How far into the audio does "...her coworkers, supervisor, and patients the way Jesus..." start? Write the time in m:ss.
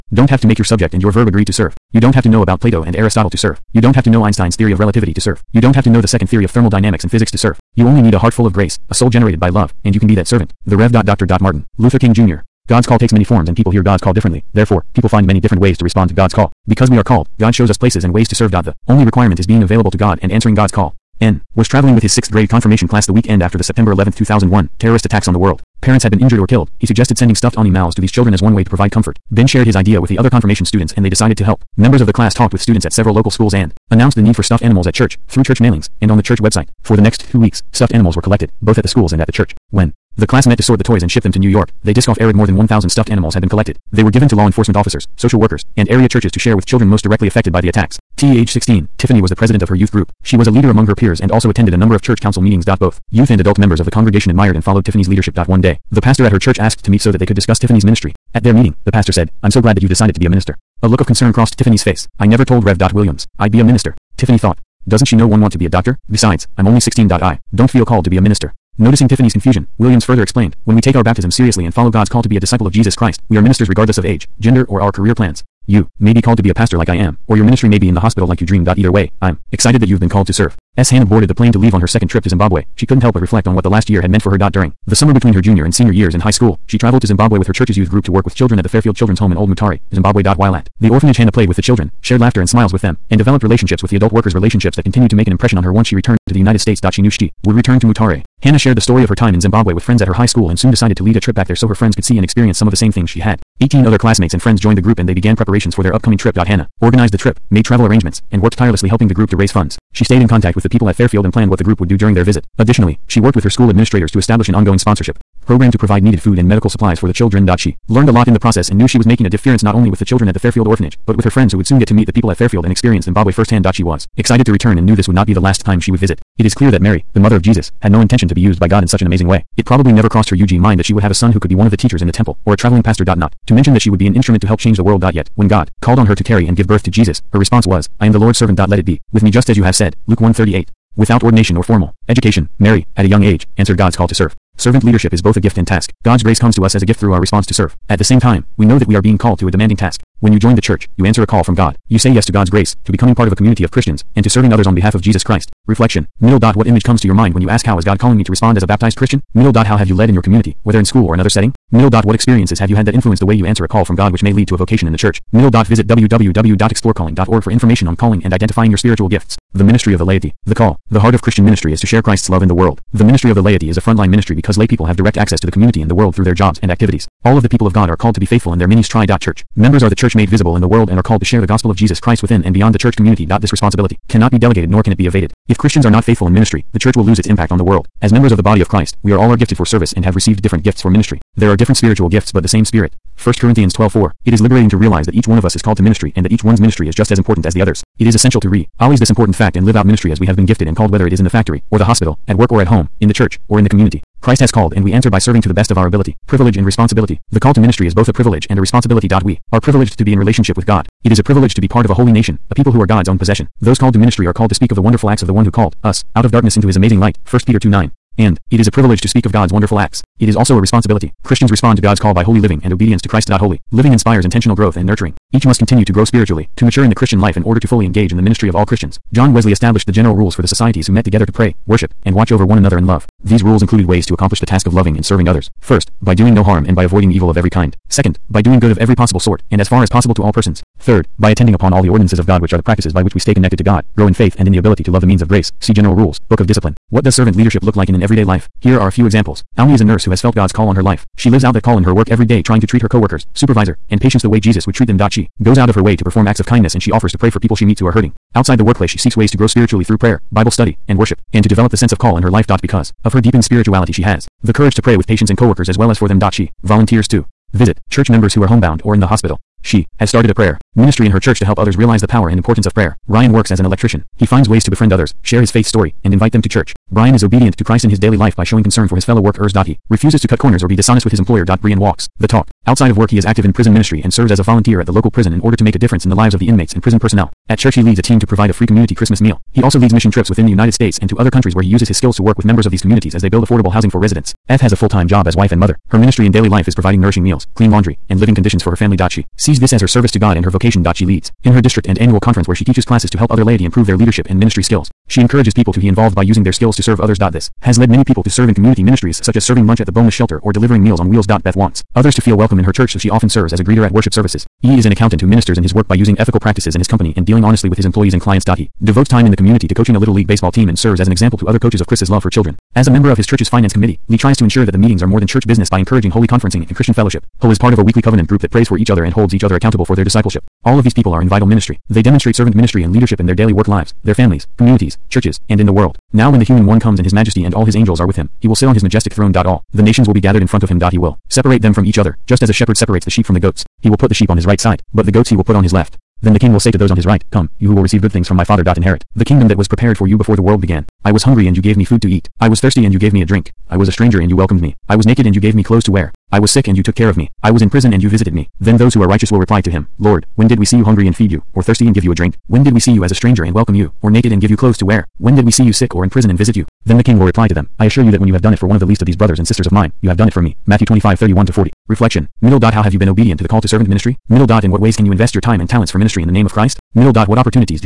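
4:12.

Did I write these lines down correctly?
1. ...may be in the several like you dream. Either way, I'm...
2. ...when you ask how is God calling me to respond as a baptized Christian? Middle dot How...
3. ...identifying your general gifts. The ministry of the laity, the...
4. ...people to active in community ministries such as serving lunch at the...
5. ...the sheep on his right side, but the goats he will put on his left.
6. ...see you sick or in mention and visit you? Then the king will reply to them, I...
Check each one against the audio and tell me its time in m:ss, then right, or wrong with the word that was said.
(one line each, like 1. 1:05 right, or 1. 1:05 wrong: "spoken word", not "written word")
1. 1:17 wrong: "hospital", not "several"
2. 2:37 right
3. 2:48 wrong: "spiritual", not "general"
4. 5:08 wrong: "serve", not "active"
5. 5:44 right
6. 6:05 wrong: "prison", not "mention".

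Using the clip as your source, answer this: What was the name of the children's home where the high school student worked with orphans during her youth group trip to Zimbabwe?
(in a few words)
Fairfield Children's Home.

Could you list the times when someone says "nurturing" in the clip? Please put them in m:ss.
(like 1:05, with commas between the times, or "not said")
3:44.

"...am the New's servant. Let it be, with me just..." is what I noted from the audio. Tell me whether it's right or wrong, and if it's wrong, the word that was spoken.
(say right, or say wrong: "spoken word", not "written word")
wrong: "Lord", not "New".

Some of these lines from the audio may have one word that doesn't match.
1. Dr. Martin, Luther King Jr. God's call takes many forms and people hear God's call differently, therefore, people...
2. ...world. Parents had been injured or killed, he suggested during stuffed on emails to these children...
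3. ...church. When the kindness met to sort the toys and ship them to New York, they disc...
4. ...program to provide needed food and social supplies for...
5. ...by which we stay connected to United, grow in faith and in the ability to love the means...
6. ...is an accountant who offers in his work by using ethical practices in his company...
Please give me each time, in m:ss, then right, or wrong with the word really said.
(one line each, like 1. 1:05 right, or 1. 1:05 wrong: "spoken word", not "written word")
1. 0:10 right
2. 0:25 wrong: "sending", not "during"
3. 0:39 wrong: "class", not "kindness"
4. 1:55 wrong: "medical", not "social"
5. 4:02 wrong: "God", not "United"
6. 5:14 wrong: "ministers", not "offers".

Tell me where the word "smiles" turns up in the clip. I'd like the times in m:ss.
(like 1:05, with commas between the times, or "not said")
1:32.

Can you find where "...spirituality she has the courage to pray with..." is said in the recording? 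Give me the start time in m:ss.
4:23.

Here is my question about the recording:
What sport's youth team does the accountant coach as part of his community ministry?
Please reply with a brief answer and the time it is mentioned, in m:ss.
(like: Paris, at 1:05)
Little League baseball, at 5:19.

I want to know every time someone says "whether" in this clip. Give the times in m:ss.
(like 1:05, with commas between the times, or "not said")
2:40, 3:20.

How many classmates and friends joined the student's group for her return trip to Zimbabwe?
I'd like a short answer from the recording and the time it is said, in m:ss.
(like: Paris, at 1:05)
18, at 1:43.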